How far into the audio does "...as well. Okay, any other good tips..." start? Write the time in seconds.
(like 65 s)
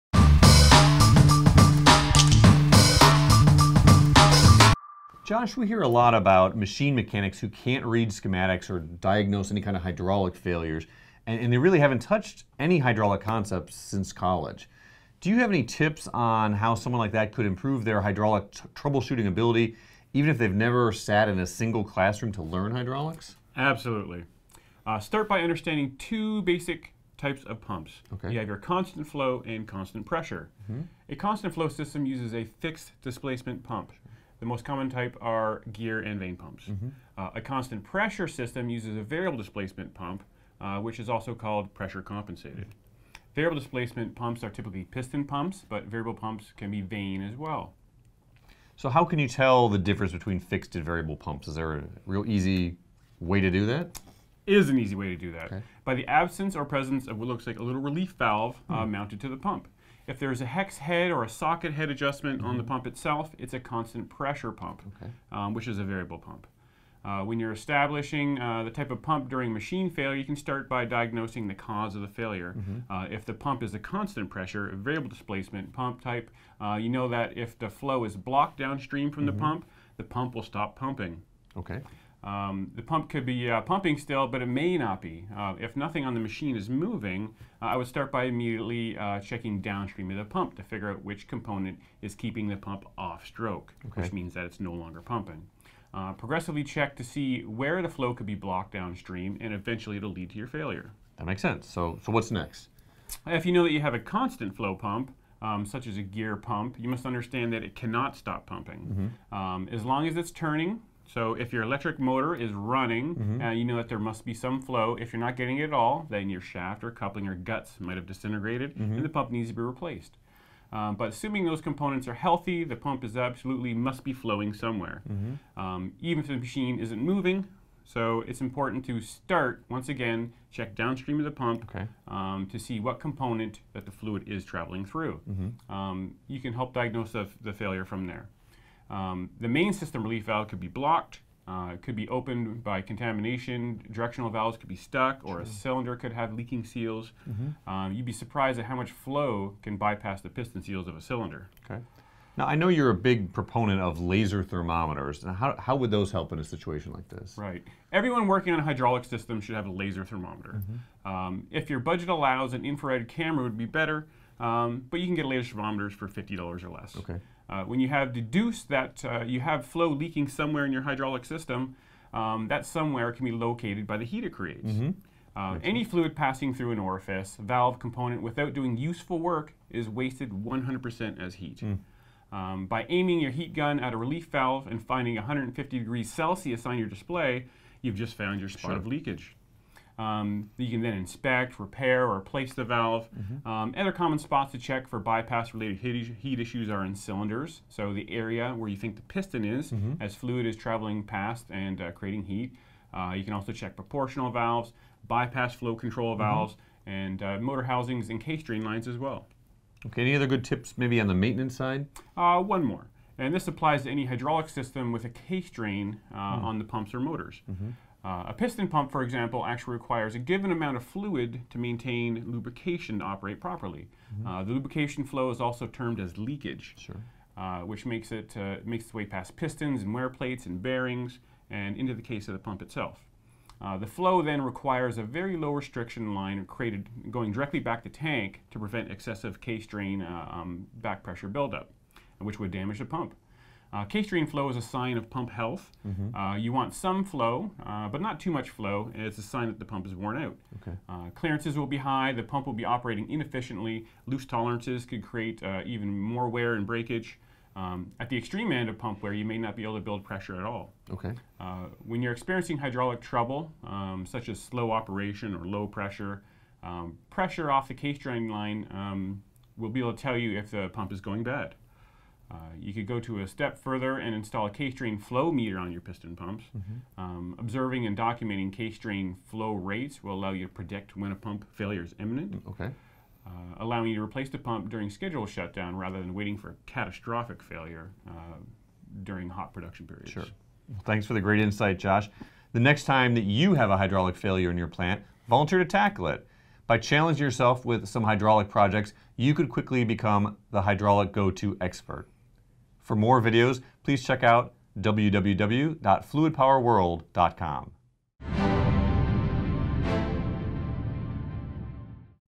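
208 s.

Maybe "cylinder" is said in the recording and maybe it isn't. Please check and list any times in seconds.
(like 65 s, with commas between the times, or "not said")
145 s, 151 s, 196 s.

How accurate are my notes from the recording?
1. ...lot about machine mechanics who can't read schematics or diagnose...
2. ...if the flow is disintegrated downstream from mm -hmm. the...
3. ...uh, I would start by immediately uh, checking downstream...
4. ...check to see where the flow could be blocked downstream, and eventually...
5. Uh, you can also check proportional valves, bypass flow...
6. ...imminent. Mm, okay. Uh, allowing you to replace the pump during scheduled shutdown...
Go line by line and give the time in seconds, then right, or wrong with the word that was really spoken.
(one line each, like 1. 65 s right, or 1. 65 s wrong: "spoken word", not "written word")
1. 5 s right
2. 77 s wrong: "blocked", not "disintegrated"
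3. 87 s right
4. 96 s right
5. 202 s right
6. 281 s right.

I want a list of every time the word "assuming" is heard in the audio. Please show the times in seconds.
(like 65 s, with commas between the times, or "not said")
121 s.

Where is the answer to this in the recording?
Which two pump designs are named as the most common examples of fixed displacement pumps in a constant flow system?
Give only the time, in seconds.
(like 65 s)
35 s.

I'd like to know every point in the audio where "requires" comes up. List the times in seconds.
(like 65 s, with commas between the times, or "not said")
219 s, 234 s.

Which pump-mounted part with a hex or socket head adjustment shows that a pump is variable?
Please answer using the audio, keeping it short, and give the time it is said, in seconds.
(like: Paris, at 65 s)
little relief valve, at 57 s.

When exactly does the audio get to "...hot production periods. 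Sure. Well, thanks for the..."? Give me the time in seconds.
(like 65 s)
289 s.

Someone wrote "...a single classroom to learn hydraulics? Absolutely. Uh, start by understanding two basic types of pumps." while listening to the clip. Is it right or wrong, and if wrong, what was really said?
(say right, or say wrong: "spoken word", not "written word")
right.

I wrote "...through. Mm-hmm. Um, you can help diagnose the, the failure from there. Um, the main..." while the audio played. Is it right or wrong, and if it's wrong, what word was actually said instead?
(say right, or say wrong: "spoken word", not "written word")
right.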